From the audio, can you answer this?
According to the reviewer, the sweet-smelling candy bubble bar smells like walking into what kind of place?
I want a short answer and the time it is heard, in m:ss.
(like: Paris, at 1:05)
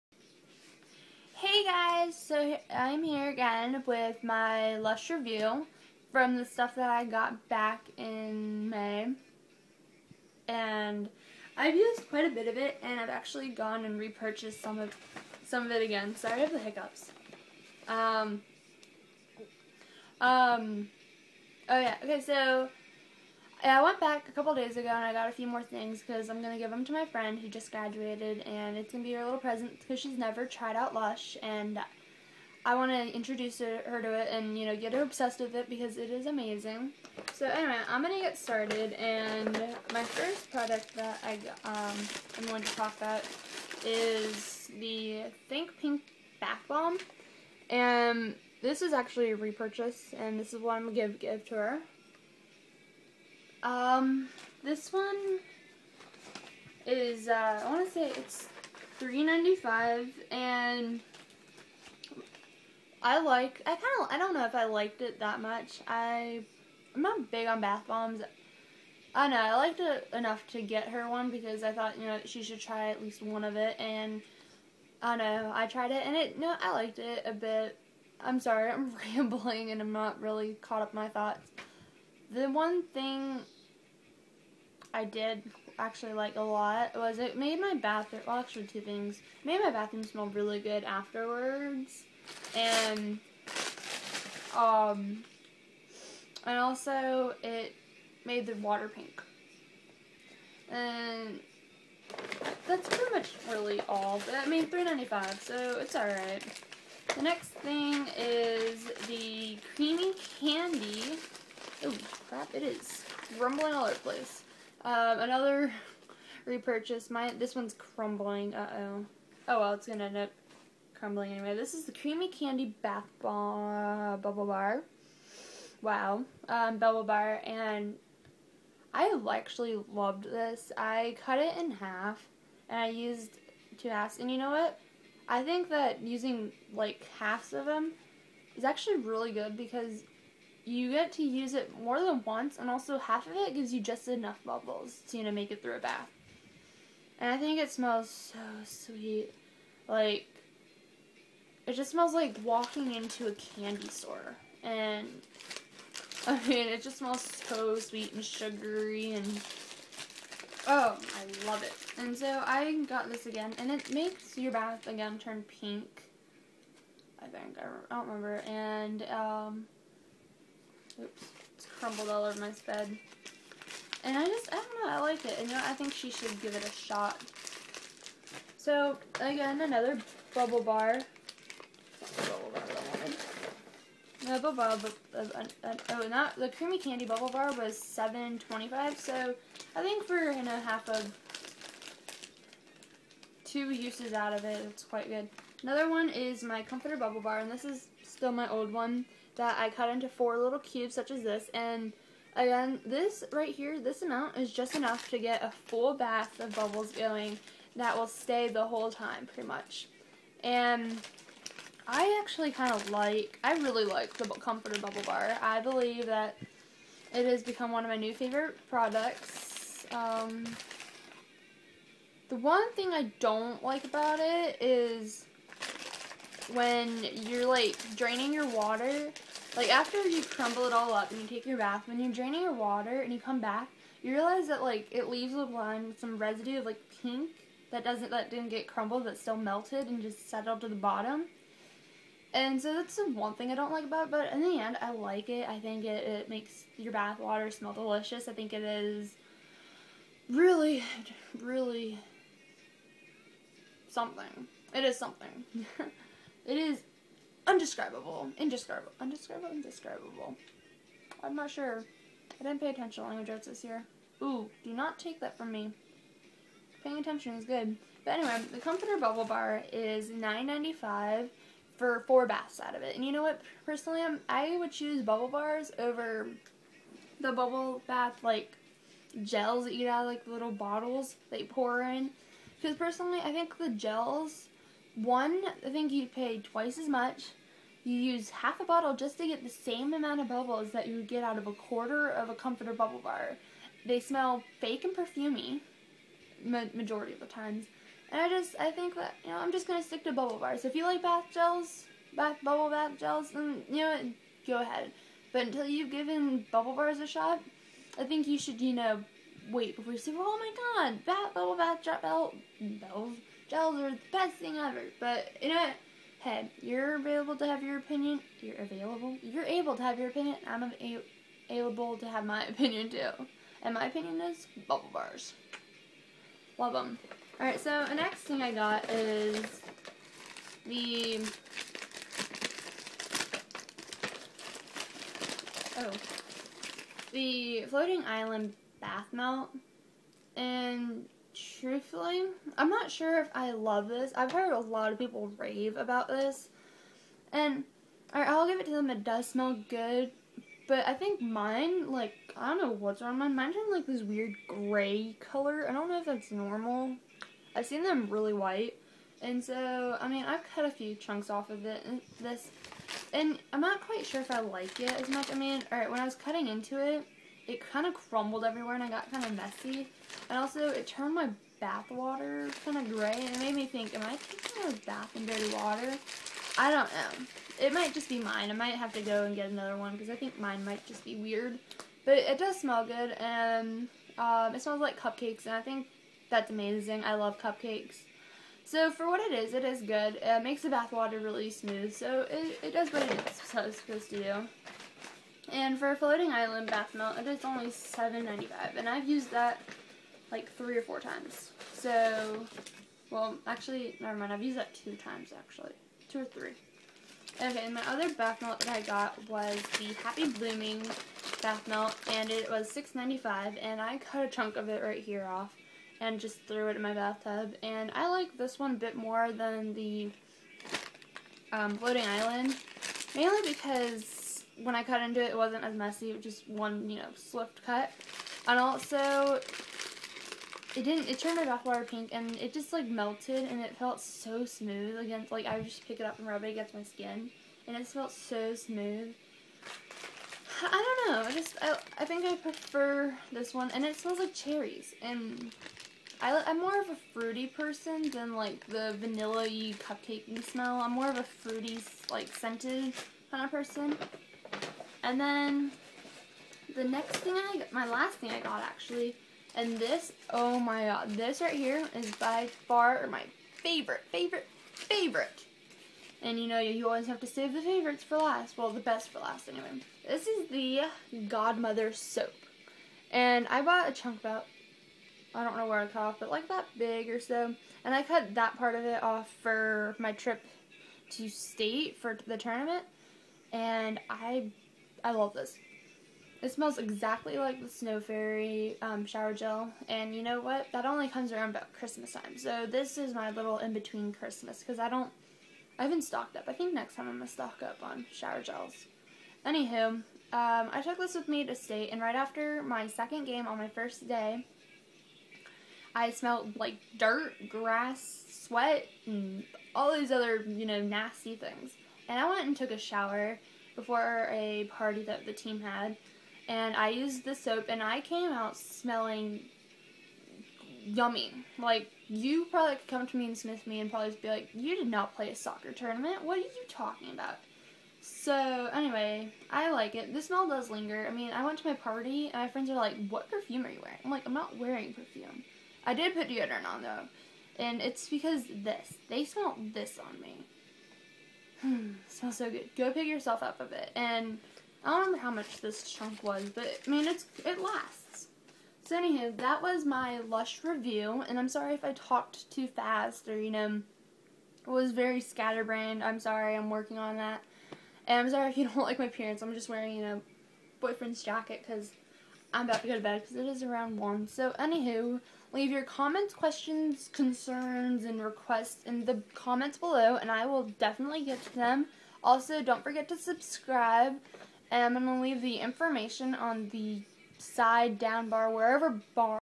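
a candy store, at 2:33.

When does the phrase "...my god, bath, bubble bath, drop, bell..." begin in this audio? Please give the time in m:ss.
5:10.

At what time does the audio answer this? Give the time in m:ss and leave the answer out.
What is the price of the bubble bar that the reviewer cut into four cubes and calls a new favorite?
4:30.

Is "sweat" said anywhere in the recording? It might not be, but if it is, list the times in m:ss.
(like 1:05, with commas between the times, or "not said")
8:28.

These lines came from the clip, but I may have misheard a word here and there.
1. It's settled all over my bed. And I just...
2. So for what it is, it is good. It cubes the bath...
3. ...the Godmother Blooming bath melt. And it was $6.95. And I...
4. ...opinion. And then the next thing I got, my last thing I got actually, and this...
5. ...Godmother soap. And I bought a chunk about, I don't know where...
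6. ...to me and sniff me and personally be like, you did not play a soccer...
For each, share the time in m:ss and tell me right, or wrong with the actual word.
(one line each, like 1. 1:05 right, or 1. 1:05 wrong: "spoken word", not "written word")
1. 2:51 wrong: "crumbled", not "settled"
2. 6:28 wrong: "makes", not "cubes"
3. 6:49 wrong: "Happy", not "Godmother"
4. 7:33 wrong: "person", not "opinion"
5. 7:51 right
6. 8:43 wrong: "probably", not "personally".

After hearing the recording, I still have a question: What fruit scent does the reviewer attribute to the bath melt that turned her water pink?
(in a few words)
cherries.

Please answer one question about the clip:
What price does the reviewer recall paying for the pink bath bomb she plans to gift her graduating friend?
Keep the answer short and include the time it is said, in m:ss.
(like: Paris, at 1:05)
$3.95, at 0:58.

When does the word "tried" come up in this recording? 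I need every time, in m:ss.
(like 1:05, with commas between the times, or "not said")
0:30, 1:15.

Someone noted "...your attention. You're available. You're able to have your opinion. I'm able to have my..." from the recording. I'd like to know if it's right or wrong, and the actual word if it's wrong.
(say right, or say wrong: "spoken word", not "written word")
wrong: "opinion", not "attention".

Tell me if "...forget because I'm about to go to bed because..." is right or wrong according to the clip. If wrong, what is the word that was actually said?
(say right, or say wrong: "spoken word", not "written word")
wrong: "jacket", not "forget".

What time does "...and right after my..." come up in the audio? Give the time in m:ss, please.
8:21.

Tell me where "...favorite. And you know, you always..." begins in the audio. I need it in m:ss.
7:44.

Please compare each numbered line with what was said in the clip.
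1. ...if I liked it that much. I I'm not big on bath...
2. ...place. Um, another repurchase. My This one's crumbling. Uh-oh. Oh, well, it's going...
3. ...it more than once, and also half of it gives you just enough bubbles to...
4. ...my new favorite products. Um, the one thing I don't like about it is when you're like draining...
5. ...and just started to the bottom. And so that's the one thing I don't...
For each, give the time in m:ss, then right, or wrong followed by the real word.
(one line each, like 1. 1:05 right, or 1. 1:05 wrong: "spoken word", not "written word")
1. 1:04 right
2. 1:53 right
3. 2:21 right
4. 3:37 right
5. 3:59 wrong: "settled", not "started".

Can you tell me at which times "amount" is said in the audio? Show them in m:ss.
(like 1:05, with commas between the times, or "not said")
3:24, 4:49.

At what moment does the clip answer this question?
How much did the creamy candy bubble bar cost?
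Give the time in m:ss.
3:07.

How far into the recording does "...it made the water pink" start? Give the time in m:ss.
1:37.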